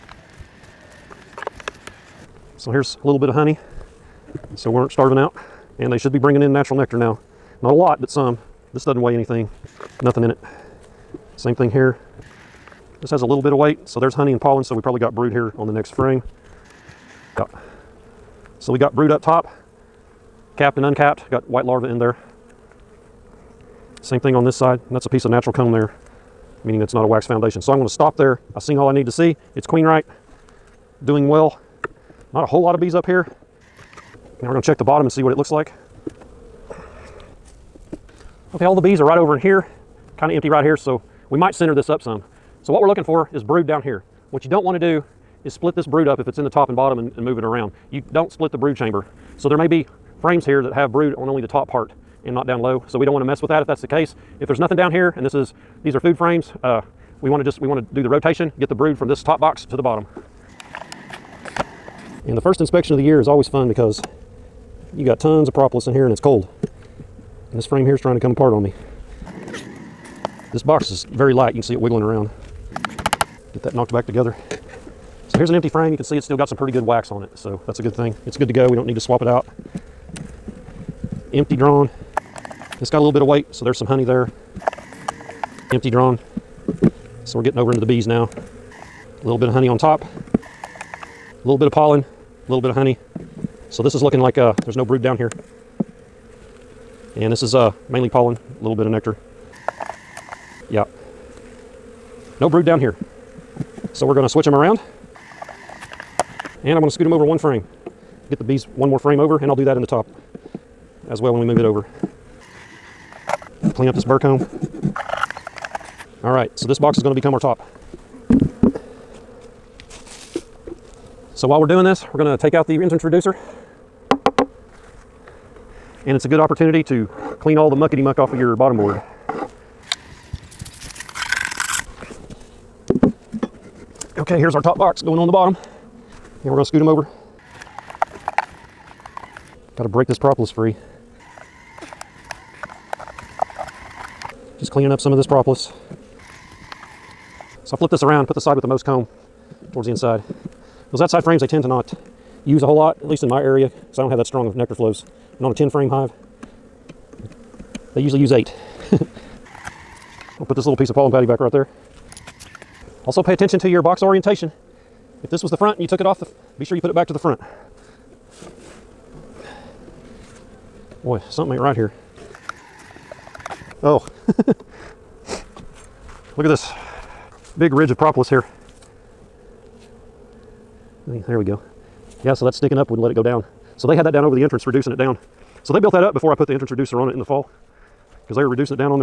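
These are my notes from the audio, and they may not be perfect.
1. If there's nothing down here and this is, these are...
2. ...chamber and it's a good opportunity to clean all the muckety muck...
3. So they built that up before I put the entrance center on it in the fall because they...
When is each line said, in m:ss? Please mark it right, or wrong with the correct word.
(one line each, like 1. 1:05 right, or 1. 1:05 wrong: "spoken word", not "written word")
1. 0:54 right
2. 2:03 wrong: "reducer", not "chamber"
3. 3:05 wrong: "reducer", not "center".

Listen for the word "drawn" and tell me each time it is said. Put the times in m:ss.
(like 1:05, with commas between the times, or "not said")
1:21, 1:25.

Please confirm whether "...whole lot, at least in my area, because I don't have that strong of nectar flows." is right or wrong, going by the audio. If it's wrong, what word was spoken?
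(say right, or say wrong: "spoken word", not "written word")
right.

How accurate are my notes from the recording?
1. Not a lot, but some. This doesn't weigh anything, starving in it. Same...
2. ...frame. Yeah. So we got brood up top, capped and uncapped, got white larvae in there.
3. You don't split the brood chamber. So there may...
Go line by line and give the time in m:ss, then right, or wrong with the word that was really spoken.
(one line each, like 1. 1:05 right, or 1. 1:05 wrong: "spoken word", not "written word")
1. 0:07 wrong: "nothing", not "starving"
2. 0:15 right
3. 0:47 right.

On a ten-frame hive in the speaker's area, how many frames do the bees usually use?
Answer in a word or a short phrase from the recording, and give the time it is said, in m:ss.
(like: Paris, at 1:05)
8, at 2:38.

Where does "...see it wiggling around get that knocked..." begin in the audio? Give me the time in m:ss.
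1:11.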